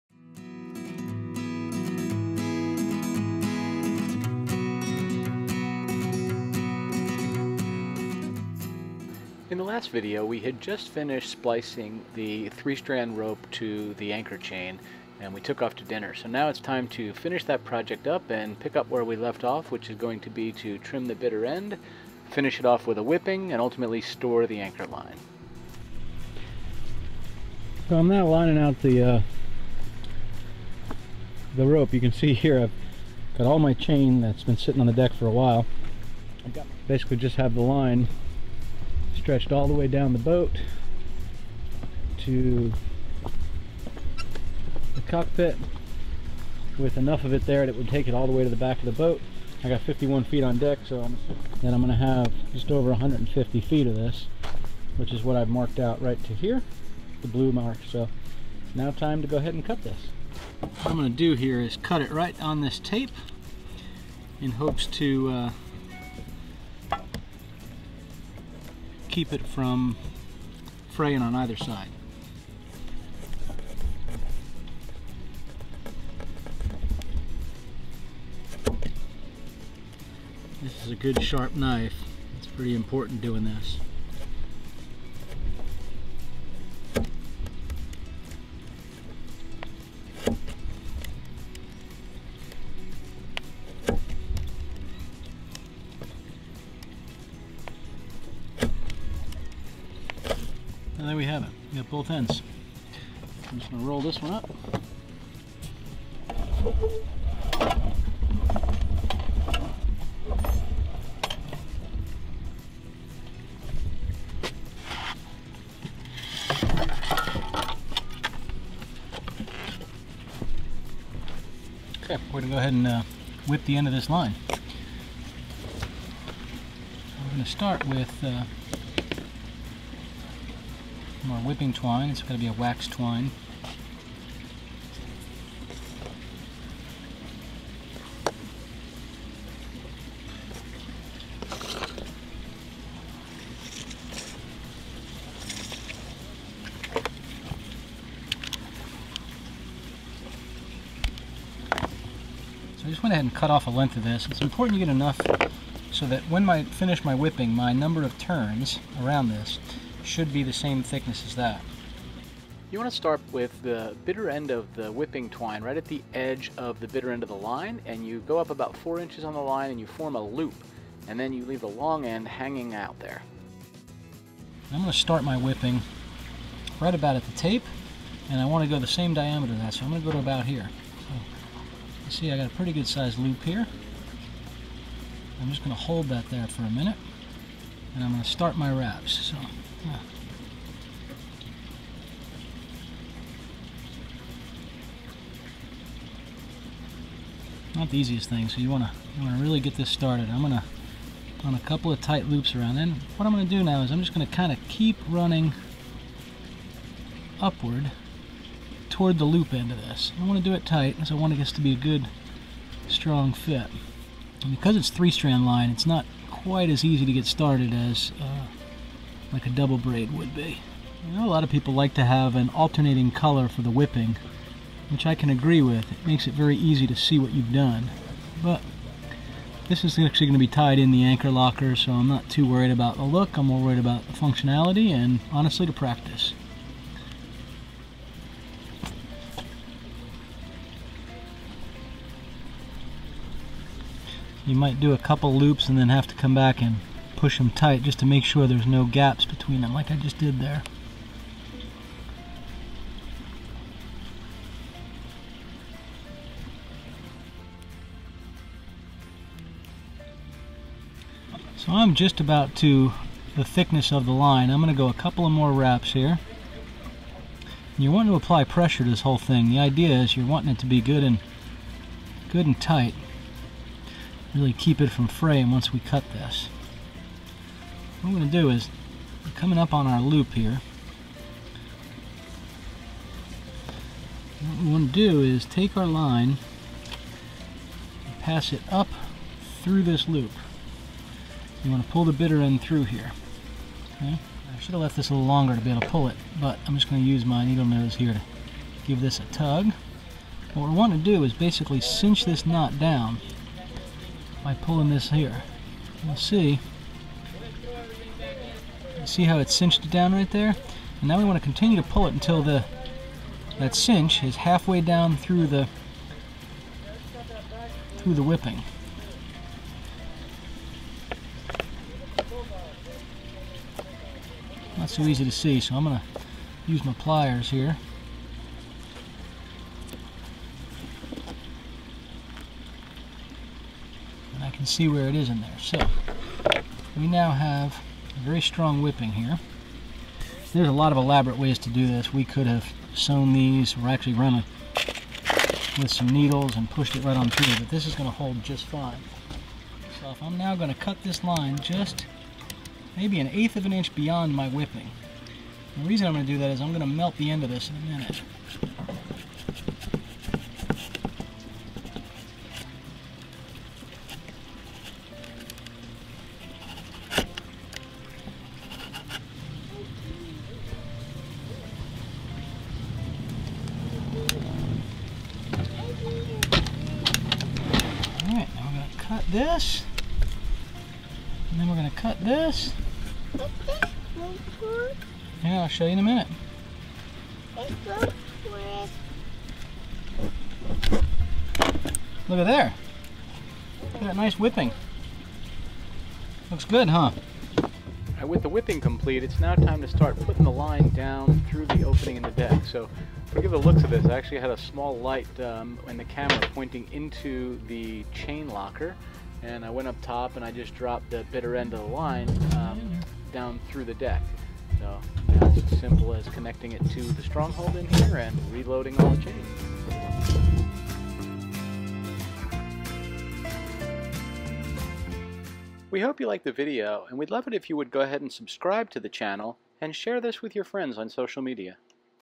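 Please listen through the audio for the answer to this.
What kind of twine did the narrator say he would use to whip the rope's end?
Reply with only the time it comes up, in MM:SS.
02:12.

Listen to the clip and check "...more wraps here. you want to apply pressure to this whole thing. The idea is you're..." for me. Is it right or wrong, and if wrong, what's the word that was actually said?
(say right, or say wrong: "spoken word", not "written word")
right.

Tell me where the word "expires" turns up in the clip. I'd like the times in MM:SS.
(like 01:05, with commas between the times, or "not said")
not said.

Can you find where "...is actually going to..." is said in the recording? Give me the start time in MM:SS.
03:49.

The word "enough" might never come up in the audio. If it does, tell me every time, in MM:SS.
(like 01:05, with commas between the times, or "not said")
00:46, 02:34.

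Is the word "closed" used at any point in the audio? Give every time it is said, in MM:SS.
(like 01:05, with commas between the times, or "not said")
not said.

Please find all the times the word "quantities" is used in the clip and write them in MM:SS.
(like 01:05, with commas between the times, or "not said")
not said.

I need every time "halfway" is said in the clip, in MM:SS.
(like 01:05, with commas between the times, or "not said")
05:14.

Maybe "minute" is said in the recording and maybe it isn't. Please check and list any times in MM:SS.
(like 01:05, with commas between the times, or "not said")
03:06, 05:57, 06:26.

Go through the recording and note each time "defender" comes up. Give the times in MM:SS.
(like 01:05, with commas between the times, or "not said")
not said.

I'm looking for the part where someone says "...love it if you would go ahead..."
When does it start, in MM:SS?
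07:07.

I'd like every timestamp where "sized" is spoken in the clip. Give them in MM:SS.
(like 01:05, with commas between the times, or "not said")
03:02.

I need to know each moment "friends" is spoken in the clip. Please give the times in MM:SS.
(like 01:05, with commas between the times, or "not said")
07:10.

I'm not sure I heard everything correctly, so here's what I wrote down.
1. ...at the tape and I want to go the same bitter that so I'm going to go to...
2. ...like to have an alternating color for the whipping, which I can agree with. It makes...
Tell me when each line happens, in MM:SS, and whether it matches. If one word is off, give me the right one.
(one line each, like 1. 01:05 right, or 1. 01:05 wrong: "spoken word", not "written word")
1. 02:57 wrong: "diameter", not "bitter"
2. 03:41 right.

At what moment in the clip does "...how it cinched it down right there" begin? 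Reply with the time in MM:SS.
05:09.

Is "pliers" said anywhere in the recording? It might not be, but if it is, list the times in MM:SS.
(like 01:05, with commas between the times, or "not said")
05:26.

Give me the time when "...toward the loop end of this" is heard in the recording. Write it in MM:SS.
03:28.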